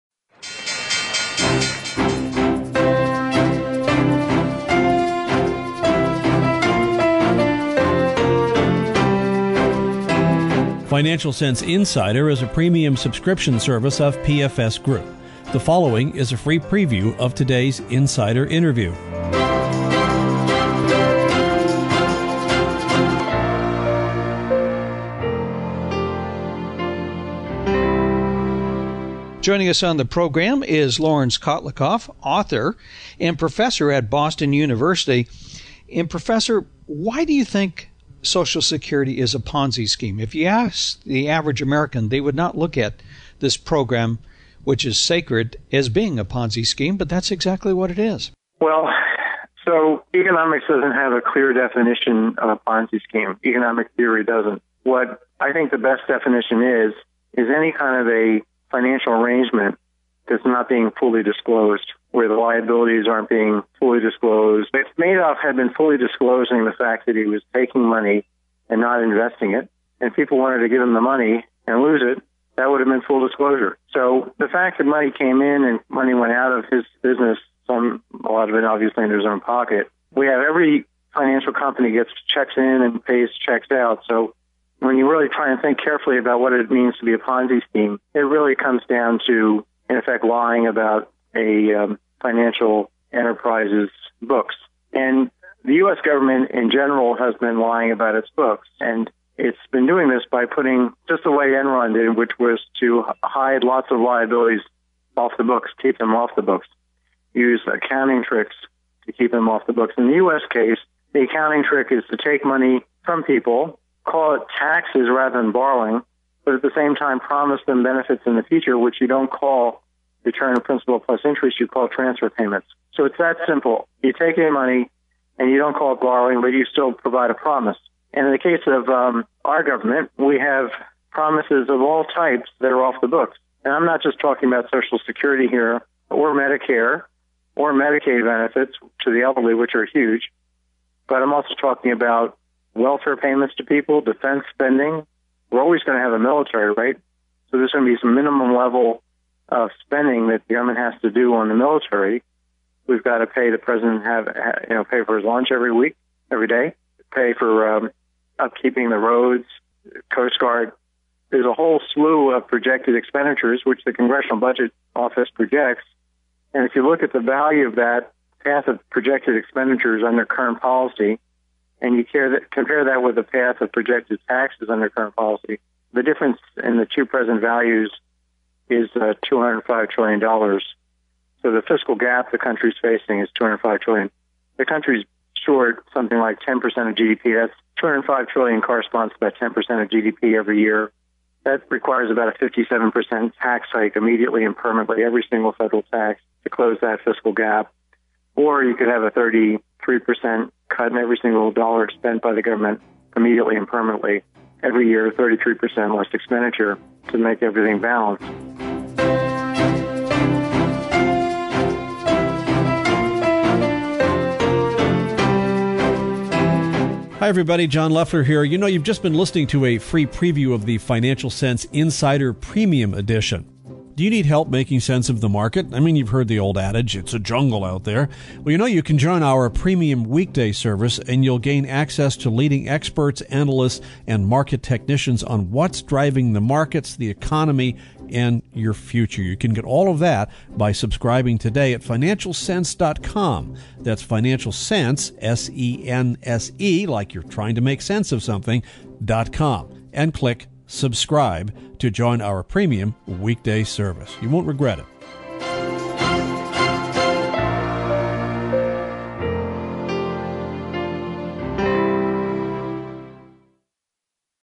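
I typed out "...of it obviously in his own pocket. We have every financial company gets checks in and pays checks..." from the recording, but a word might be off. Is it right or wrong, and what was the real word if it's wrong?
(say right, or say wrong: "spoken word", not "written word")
right.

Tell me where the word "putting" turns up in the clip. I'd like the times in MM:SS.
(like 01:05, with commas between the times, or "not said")
01:40.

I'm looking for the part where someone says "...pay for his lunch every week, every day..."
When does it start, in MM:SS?
02:34.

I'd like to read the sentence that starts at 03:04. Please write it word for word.
The country's short something like 10% of GDP.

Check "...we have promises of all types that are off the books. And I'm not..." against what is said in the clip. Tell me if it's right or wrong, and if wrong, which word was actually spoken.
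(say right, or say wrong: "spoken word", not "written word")
right.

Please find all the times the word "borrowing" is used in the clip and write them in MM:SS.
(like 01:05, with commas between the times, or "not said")
01:55, 02:05.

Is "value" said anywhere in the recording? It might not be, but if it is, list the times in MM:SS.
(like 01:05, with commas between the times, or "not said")
02:47, 02:57.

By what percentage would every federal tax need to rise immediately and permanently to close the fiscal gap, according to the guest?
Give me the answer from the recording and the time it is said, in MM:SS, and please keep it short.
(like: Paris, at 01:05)
57%, at 03:12.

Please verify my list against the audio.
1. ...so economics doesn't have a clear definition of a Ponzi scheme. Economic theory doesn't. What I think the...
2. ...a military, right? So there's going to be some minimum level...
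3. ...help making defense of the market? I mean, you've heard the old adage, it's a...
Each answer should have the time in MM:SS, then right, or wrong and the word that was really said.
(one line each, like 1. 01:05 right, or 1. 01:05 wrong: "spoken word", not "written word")
1. 00:49 right
2. 02:26 right
3. 03:44 wrong: "sense", not "defense".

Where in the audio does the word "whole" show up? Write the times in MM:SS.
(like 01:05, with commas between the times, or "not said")
02:41.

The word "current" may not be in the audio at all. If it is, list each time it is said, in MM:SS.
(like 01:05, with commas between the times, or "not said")
02:50, 02:54.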